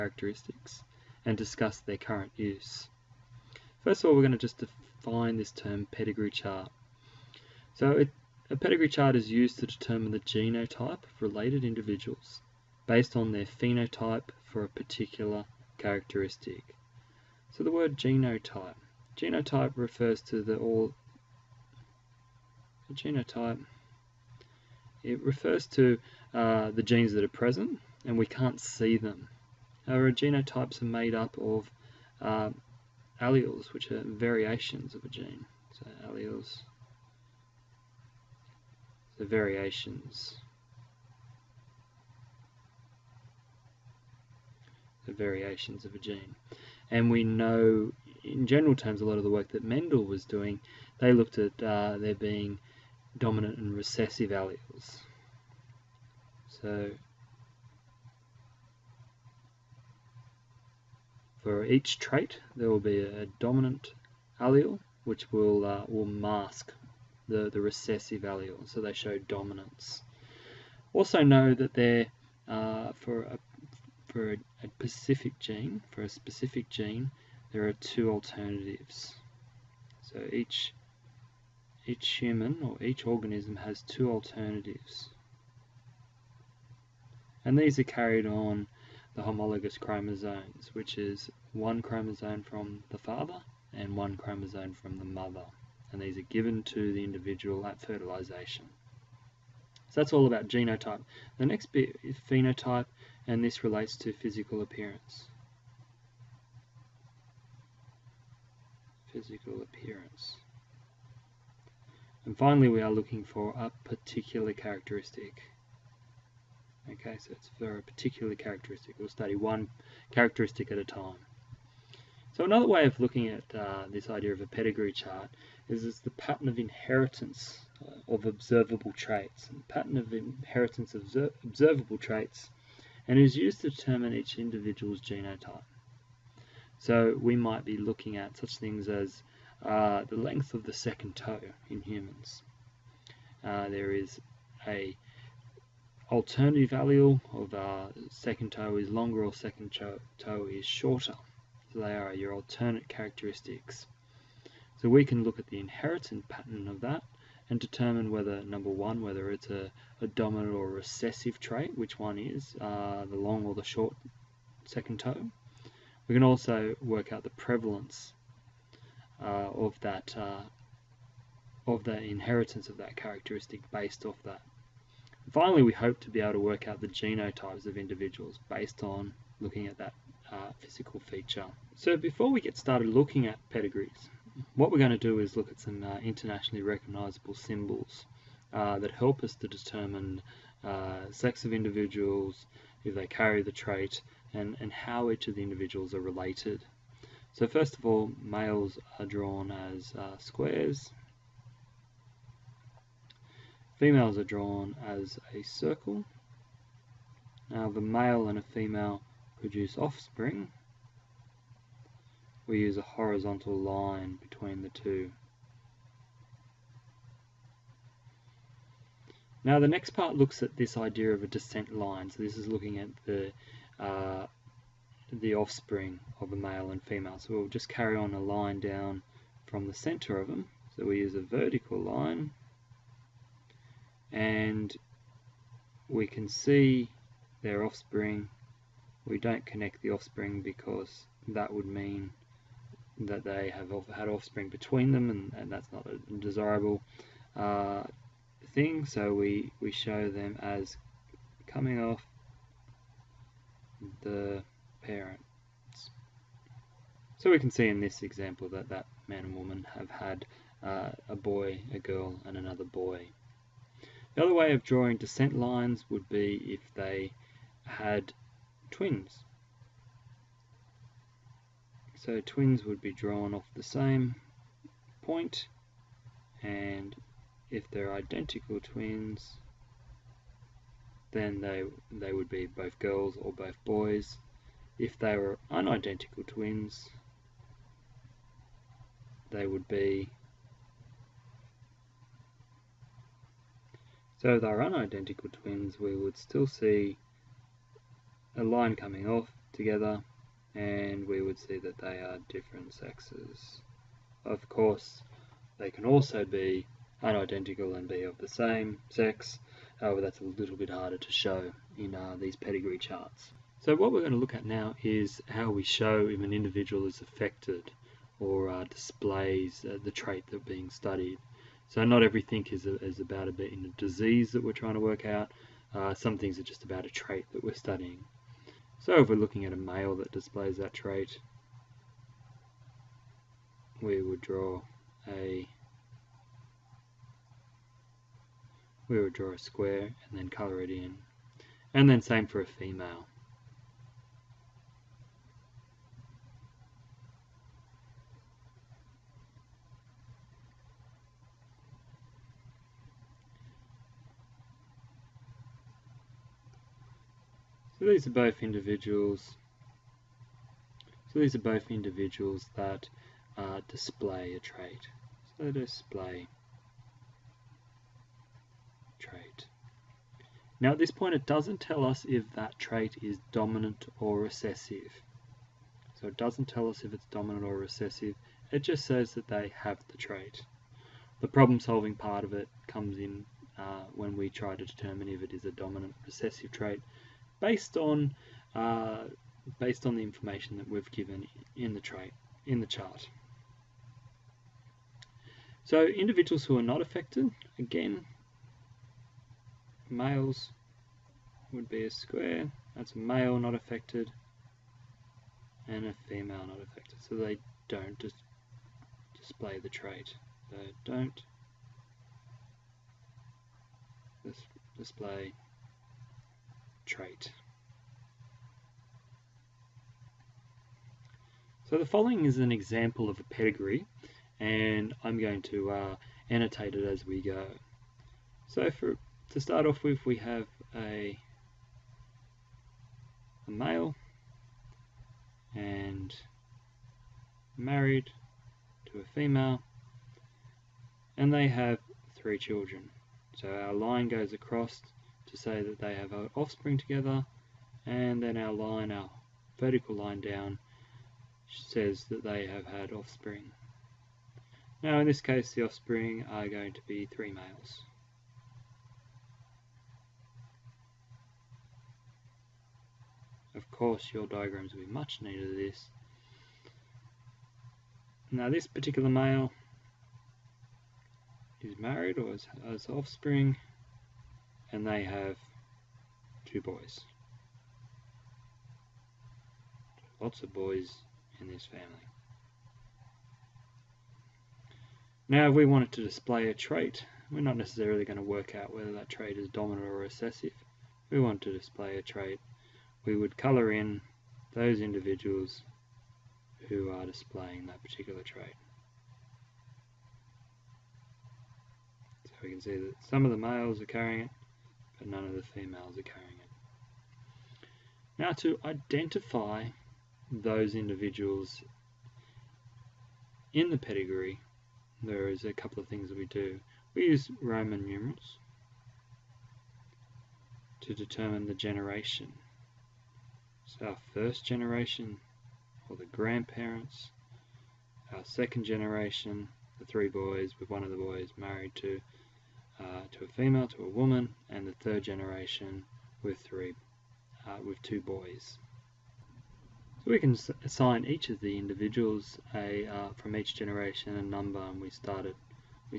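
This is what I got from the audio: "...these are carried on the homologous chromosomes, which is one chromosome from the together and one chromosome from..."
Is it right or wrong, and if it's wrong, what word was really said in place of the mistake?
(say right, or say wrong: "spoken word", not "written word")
wrong: "father", not "together".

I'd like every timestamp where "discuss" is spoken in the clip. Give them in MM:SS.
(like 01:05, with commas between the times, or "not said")
00:01.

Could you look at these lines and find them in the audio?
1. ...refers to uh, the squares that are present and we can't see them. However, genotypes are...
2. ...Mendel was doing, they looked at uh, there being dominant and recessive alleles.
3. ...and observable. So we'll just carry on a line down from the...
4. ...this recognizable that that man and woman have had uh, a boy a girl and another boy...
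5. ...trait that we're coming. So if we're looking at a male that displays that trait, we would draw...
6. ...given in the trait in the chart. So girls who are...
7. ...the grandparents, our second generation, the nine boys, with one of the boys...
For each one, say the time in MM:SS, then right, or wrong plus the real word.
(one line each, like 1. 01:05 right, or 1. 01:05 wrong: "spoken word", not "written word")
1. 00:25 wrong: "genes", not "squares"
2. 00:49 right
3. 03:46 wrong: "female", not "observable"
4. 04:17 wrong: "example", not "recognizable"
5. 05:26 wrong: "studying", not "coming"
6. 06:30 wrong: "individuals", not "girls"
7. 08:45 wrong: "three", not "nine".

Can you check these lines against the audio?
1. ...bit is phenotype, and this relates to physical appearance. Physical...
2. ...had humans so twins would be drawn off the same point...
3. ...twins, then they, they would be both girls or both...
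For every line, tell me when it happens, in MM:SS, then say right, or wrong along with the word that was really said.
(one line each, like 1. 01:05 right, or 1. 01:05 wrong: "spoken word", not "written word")
1. 01:41 right
2. 04:27 wrong: "twins", not "humans"
3. 04:38 right.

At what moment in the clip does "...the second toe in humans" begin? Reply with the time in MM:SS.
02:20.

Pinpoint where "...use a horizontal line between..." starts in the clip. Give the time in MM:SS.
03:32.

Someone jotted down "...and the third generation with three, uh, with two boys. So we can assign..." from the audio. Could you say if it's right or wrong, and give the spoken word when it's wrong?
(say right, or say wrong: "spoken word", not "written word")
right.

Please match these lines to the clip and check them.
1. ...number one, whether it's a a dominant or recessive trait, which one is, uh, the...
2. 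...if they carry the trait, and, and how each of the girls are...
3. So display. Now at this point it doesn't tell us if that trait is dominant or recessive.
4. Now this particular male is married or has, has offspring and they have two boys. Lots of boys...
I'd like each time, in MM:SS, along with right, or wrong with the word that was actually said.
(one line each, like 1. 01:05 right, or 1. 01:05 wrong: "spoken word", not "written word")
1. 02:38 right
2. 03:12 wrong: "individuals", not "girls"
3. 06:05 right
4. 07:48 right.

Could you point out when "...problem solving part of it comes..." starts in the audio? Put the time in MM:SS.
06:21.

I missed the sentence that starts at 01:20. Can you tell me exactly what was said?
So each each human or each organism has two alternatives.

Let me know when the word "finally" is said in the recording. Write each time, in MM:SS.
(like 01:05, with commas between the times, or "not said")
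01:52, 02:55.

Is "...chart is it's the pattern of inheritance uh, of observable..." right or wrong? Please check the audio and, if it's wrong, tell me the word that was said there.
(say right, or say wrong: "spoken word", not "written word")
right.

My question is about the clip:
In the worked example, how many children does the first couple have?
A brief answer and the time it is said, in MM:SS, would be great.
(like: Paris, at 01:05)
3, at 07:22.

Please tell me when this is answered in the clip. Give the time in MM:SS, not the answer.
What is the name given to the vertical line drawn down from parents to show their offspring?
03:41.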